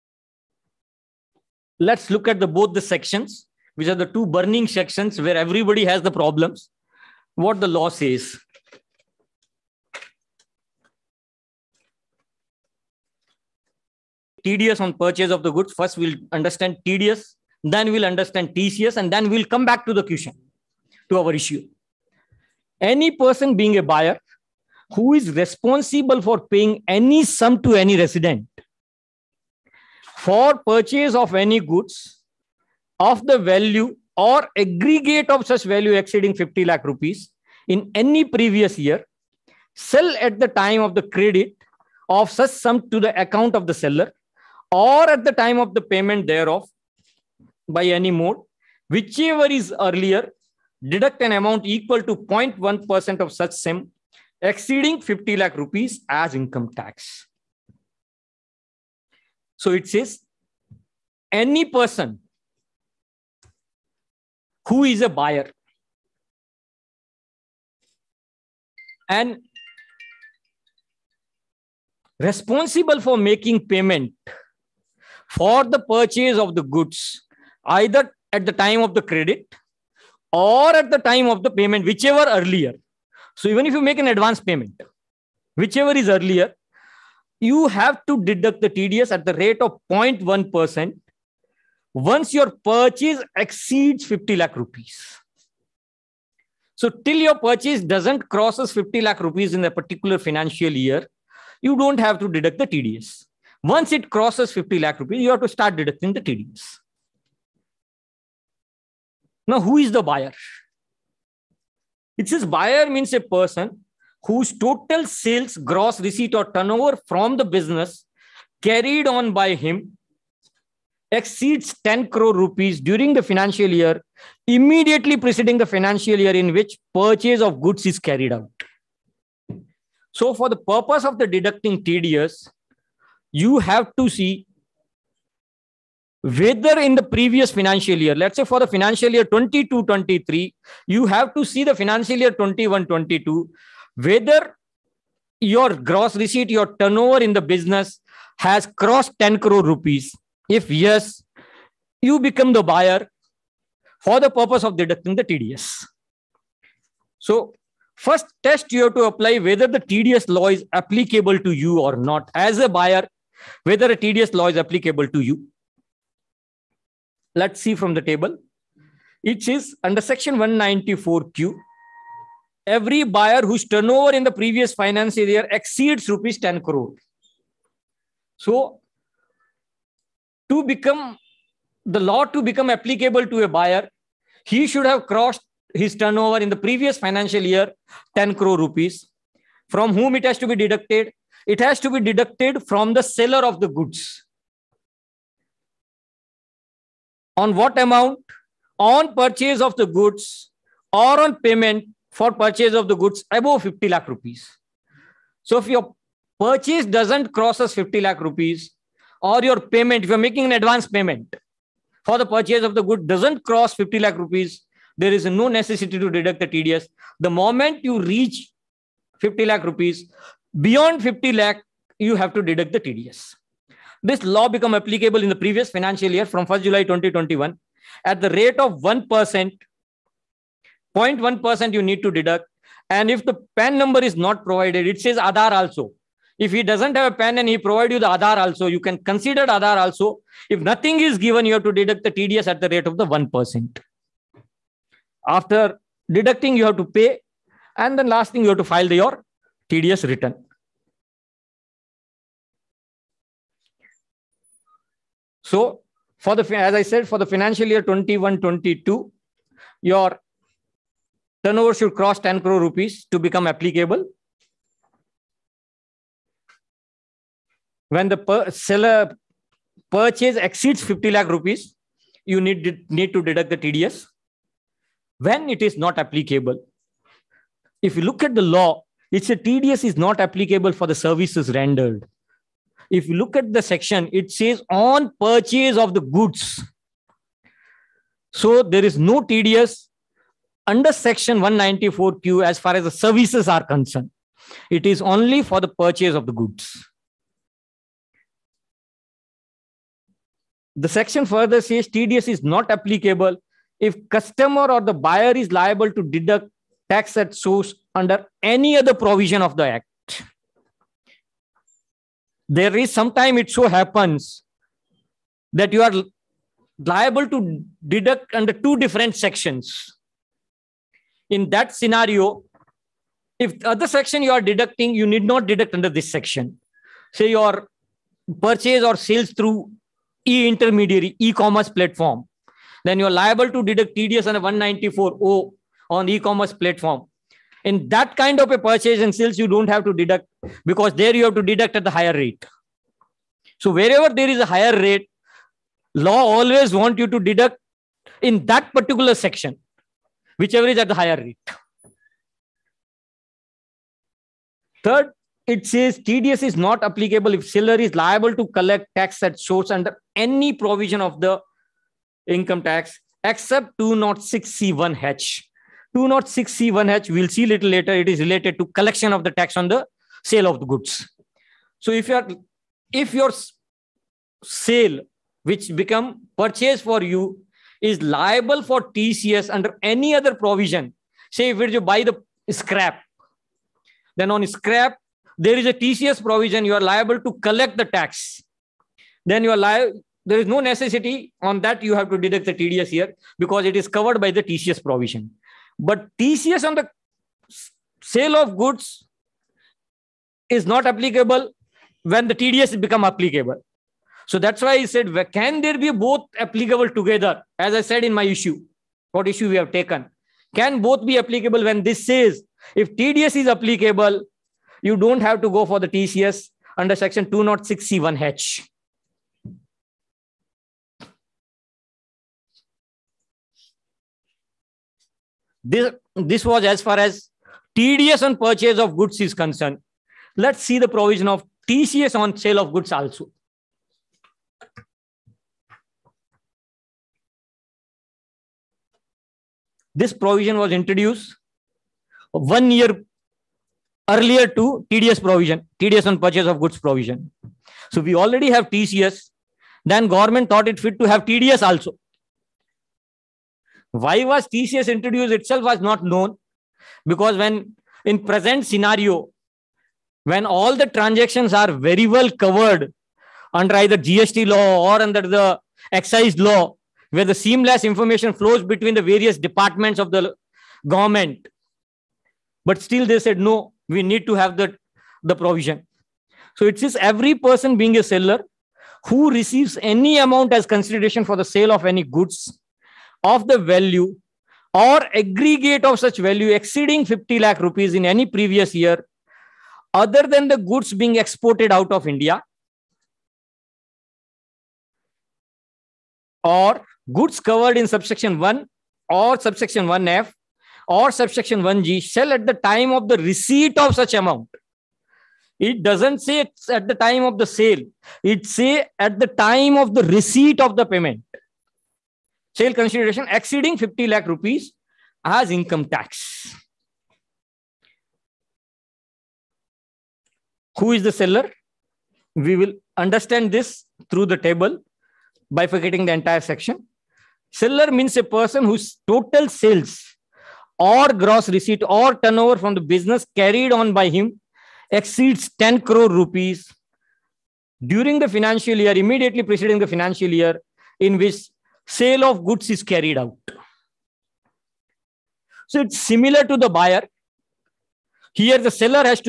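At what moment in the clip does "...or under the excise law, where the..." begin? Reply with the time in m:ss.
7:44.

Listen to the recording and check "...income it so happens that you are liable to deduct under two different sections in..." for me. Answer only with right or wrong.
wrong.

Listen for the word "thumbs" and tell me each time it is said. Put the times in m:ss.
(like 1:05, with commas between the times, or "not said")
not said.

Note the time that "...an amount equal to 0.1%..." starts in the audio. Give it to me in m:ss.
0:51.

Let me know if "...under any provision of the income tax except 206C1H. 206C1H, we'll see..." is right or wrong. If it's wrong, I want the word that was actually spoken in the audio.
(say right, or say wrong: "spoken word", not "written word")
right.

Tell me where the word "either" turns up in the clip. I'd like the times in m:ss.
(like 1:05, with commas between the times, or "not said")
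1:17, 7:43.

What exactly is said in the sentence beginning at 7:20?
this provision was introduced one year earlier to TDS provision, TDS on purchase of goods provision.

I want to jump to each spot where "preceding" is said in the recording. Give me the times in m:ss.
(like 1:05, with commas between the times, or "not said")
2:05, 8:59.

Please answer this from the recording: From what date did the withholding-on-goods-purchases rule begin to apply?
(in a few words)
1st July 2021.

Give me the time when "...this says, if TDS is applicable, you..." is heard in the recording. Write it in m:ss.
6:51.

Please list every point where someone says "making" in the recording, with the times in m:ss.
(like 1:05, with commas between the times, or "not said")
1:13, 3:30.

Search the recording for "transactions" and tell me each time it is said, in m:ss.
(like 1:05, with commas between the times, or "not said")
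7:40.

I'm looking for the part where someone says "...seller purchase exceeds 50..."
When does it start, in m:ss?
4:28.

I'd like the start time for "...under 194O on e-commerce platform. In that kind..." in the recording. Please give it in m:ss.
5:34.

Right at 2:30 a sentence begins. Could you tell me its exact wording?
If yes, you become the buyer for the purpose of deducting the TDS.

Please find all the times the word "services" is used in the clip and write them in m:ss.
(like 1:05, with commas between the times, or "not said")
4:40, 4:53.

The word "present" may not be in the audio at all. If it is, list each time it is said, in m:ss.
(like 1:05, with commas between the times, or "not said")
7:38.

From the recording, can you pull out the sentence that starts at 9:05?
So it's similar to the buyer.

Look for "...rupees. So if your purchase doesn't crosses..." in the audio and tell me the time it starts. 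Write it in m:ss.
3:24.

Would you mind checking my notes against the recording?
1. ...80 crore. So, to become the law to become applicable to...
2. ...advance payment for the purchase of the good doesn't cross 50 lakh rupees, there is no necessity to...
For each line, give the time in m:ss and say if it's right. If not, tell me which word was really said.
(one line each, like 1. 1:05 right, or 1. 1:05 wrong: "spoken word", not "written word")
1. 2:56 wrong: "10", not "80"
2. 3:30 right.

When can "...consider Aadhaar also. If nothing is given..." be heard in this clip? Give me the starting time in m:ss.
3:59.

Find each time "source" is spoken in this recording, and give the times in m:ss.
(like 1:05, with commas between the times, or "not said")
5:07, 5:59.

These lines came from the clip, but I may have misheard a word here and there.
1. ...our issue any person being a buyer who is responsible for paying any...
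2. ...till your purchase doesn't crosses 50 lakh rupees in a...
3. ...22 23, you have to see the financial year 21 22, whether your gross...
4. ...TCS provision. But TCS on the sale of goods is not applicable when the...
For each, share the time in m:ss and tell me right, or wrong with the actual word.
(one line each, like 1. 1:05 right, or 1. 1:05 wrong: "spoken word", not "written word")
1. 0:21 right
2. 1:36 right
3. 2:19 right
4. 6:34 right.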